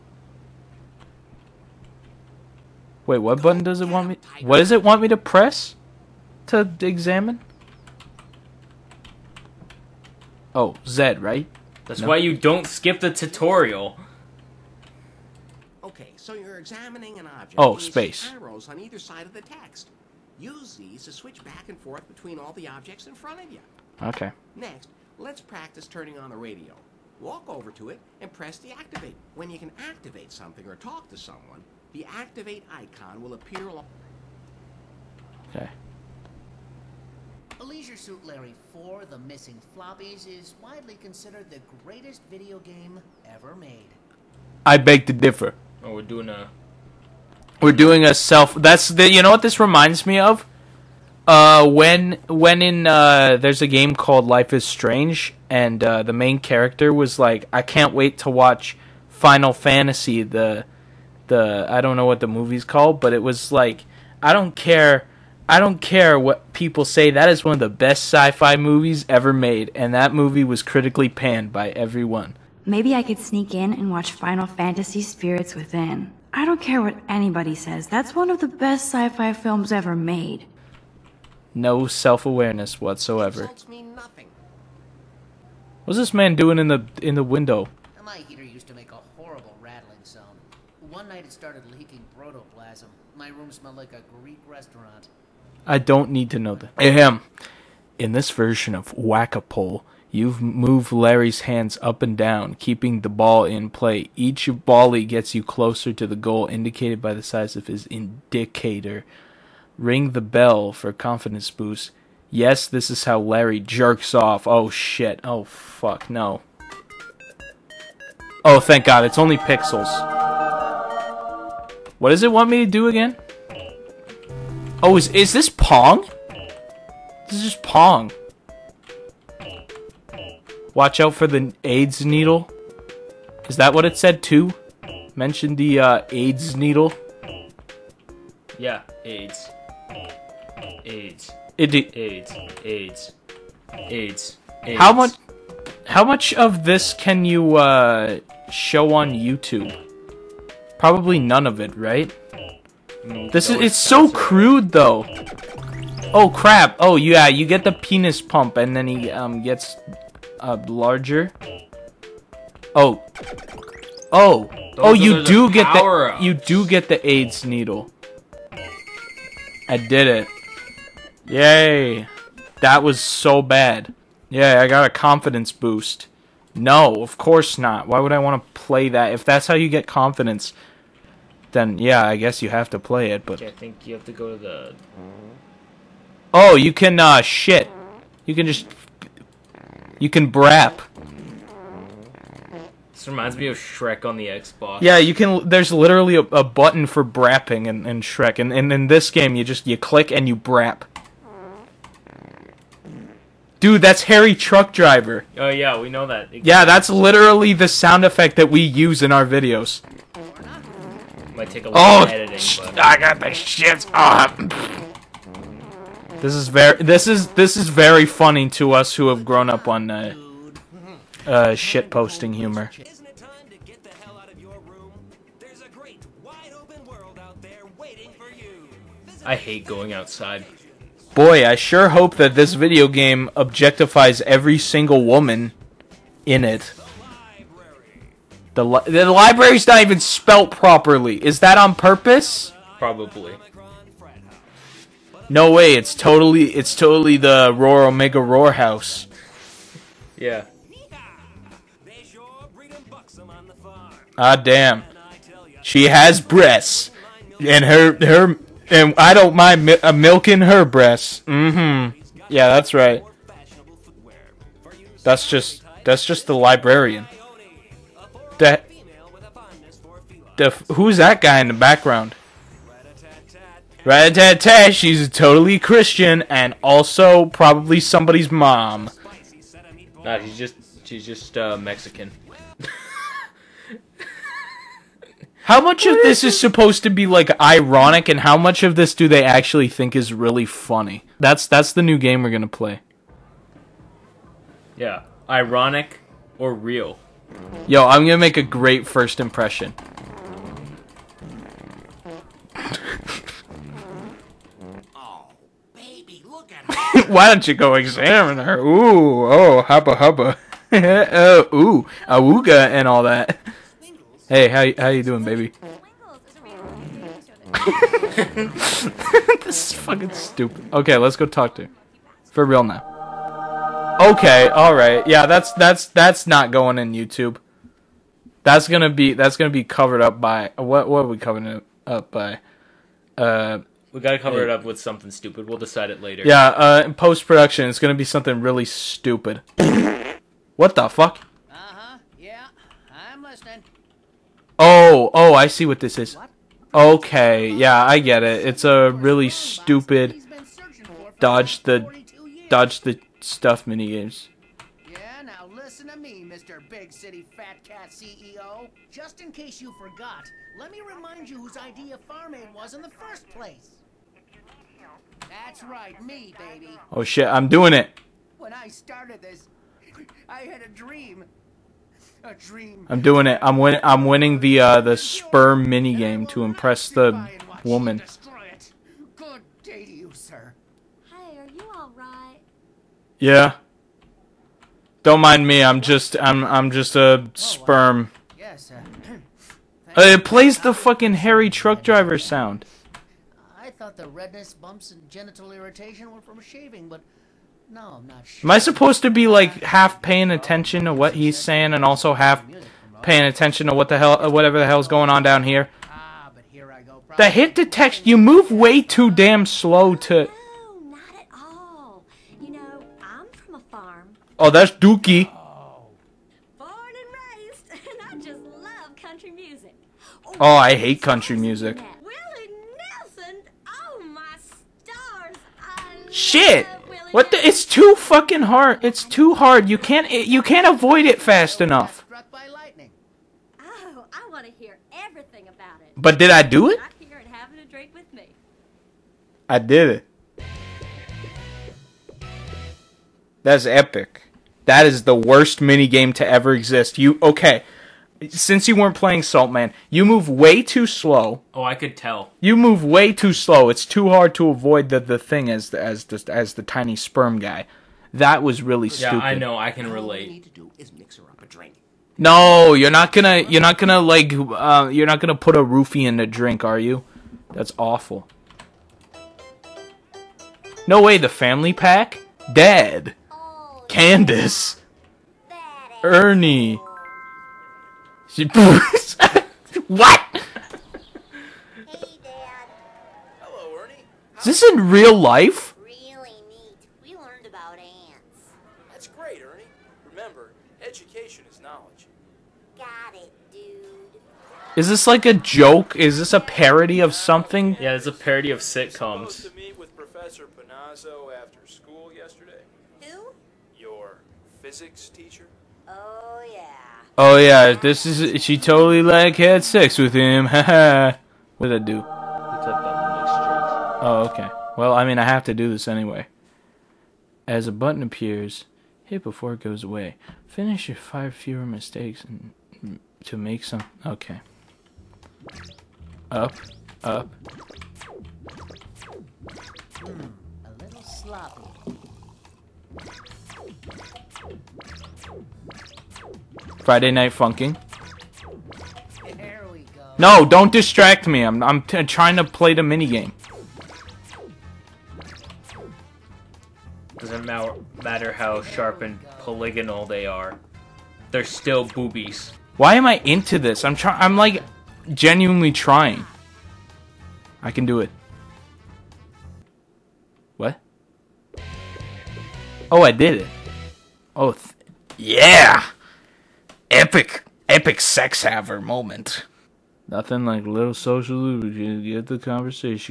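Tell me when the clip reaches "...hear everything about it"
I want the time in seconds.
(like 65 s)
434 s.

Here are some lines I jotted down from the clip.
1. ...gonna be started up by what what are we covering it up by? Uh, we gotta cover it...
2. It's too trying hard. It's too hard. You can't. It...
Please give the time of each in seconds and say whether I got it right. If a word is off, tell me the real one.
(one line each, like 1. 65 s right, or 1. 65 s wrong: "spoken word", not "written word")
1. 329 s wrong: "covered", not "started"
2. 427 s wrong: "fucking", not "trying".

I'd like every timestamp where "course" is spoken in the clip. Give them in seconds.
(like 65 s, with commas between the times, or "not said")
177 s.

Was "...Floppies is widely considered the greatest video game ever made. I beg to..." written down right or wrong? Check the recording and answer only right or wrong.
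right.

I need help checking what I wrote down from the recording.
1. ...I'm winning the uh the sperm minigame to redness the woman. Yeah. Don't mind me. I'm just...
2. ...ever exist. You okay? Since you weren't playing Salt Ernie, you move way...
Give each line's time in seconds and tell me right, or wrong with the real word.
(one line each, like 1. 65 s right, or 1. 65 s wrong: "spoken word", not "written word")
1. 373 s wrong: "impress", not "redness"
2. 446 s wrong: "Man", not "Ernie".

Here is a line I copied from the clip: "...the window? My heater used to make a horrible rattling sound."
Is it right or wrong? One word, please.
right.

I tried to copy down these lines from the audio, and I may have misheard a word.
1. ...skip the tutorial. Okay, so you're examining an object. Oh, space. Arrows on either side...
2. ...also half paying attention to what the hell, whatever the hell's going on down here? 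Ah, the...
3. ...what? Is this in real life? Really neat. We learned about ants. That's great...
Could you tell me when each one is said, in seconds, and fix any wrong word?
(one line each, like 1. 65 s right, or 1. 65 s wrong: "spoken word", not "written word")
1. 12 s right
2. 401 s right
3. 479 s right.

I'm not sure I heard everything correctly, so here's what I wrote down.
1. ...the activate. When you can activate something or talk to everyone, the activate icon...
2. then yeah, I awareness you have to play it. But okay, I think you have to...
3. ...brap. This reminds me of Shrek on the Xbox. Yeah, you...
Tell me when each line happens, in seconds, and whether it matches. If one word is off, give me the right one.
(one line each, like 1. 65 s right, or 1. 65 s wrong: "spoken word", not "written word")
1. 28 s wrong: "someone", not "everyone"
2. 181 s wrong: "guess", not "awareness"
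3. 190 s right.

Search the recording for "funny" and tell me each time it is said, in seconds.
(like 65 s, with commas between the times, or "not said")
218 s, 290 s.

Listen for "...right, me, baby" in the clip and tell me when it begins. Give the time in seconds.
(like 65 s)
365 s.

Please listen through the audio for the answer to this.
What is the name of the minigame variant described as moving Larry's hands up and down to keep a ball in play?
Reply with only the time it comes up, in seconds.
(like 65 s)
98 s.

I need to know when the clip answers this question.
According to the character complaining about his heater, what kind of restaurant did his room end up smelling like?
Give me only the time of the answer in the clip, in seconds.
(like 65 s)
94 s.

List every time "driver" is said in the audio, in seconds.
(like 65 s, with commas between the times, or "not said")
204 s, 391 s.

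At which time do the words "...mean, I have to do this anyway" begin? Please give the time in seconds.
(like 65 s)
515 s.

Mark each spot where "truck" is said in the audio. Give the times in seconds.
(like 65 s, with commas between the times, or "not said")
204 s, 391 s.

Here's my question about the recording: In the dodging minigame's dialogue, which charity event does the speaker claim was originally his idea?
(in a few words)
Farm Aid.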